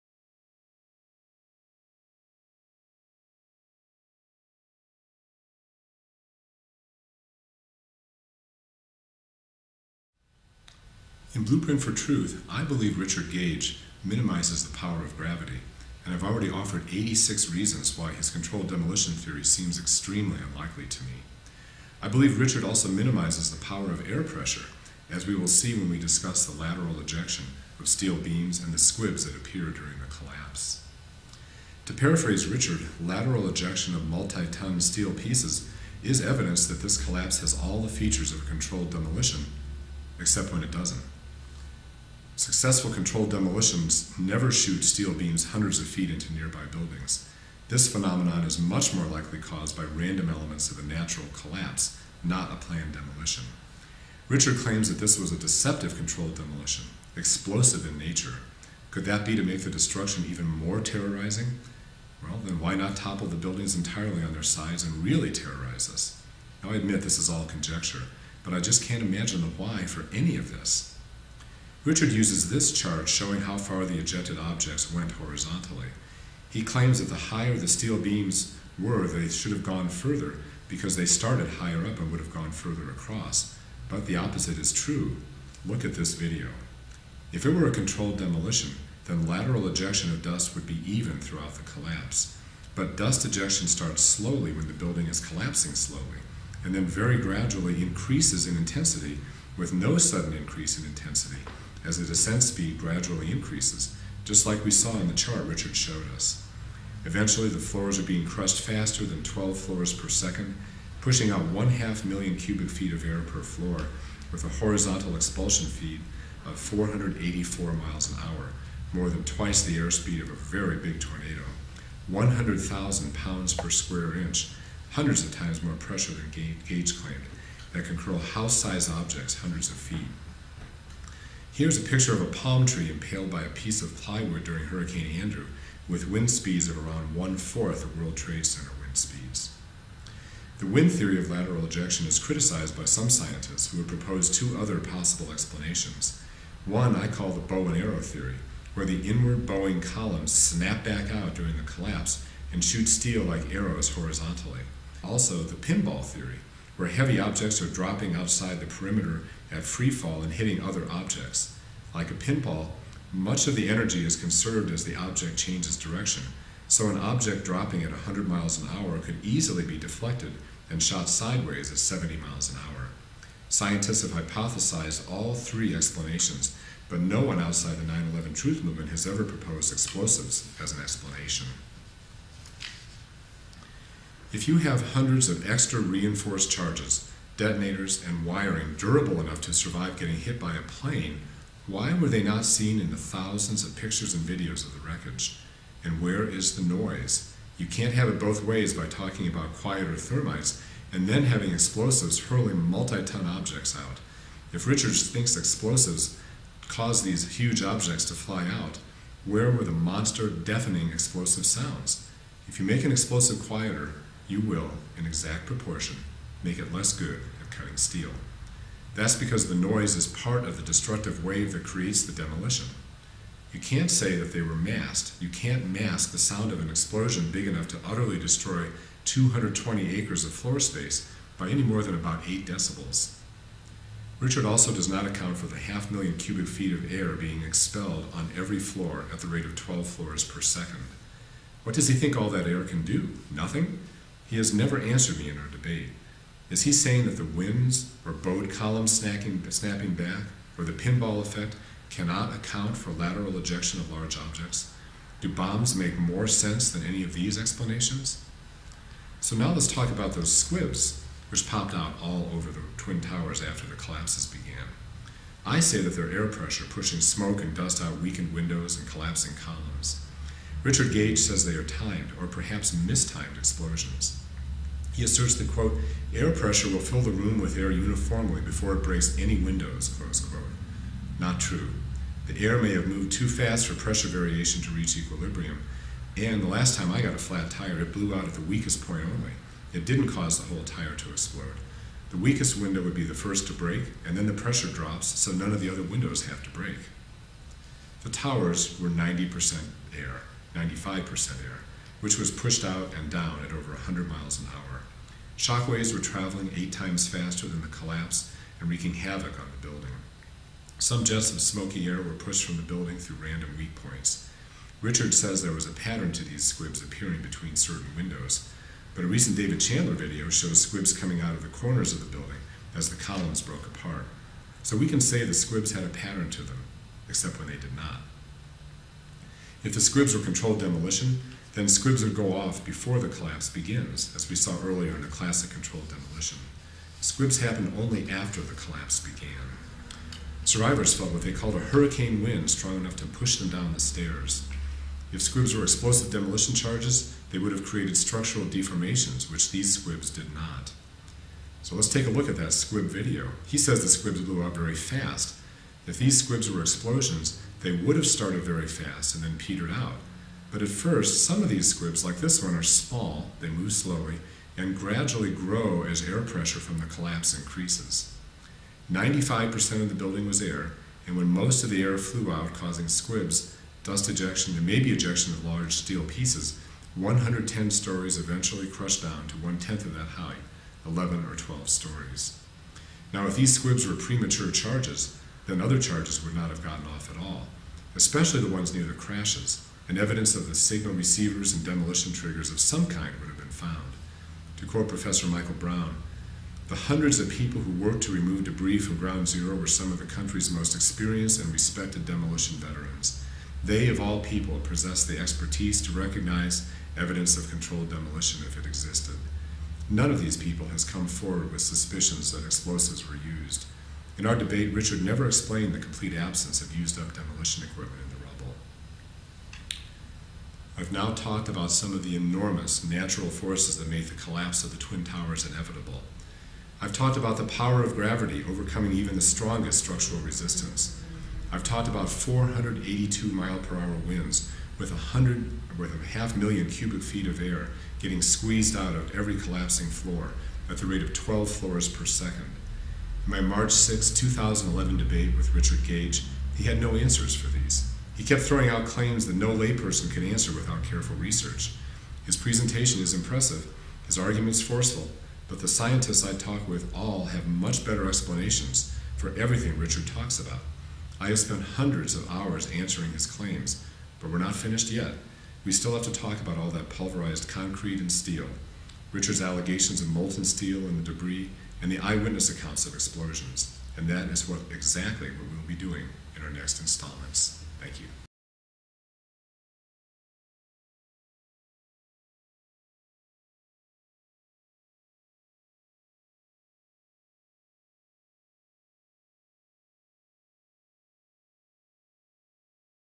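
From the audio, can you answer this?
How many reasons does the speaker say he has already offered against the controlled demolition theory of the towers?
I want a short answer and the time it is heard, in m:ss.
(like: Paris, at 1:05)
86, at 0:16.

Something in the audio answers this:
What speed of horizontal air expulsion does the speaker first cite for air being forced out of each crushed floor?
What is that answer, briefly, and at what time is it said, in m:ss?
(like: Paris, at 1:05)
484 miles an hour, at 1:56.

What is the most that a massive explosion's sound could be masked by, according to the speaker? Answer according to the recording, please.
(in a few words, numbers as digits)
8 decibels.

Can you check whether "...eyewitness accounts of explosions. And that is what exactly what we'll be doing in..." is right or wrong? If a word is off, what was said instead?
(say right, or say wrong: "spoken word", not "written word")
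right.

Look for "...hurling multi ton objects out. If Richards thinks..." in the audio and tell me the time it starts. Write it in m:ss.
3:22.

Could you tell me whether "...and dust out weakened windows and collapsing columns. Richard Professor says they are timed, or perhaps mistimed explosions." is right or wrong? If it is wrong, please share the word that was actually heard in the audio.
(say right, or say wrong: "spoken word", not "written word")
wrong: "Gage", not "Professor".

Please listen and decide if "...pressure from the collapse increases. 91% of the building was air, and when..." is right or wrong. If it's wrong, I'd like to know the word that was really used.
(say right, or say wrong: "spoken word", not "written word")
wrong: "95", not "91".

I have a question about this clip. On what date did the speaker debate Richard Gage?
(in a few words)
March 6, 2011.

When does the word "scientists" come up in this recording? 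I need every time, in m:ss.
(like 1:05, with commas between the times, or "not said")
2:23, 2:53, 7:35.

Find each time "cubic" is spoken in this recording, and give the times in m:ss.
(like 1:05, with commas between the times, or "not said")
1:52, 3:56, 7:16.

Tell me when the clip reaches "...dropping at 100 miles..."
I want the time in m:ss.
2:47.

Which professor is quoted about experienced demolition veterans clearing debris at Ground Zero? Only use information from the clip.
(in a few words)
Michael Brown.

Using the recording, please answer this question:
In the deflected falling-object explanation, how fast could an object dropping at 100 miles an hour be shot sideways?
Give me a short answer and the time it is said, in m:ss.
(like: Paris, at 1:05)
70 miles an hour, at 2:51.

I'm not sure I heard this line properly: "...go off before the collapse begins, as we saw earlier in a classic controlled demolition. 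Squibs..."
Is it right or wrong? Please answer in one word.
right.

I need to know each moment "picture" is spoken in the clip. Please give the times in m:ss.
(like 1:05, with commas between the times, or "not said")
2:11, 3:13.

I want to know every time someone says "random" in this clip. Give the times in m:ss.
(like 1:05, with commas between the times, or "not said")
0:49, 5:13.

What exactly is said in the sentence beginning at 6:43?
They, of all people, possessed the expertise to recognize evidence of controlled demolition if it existed.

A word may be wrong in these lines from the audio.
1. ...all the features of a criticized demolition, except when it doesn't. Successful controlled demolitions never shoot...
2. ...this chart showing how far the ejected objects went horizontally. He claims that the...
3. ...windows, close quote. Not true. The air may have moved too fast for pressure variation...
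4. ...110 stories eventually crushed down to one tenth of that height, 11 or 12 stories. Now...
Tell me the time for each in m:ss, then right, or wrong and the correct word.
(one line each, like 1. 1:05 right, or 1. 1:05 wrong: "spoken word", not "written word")
1. 0:37 wrong: "controlled", not "criticized"
2. 1:12 right
3. 4:39 right
4. 6:16 right.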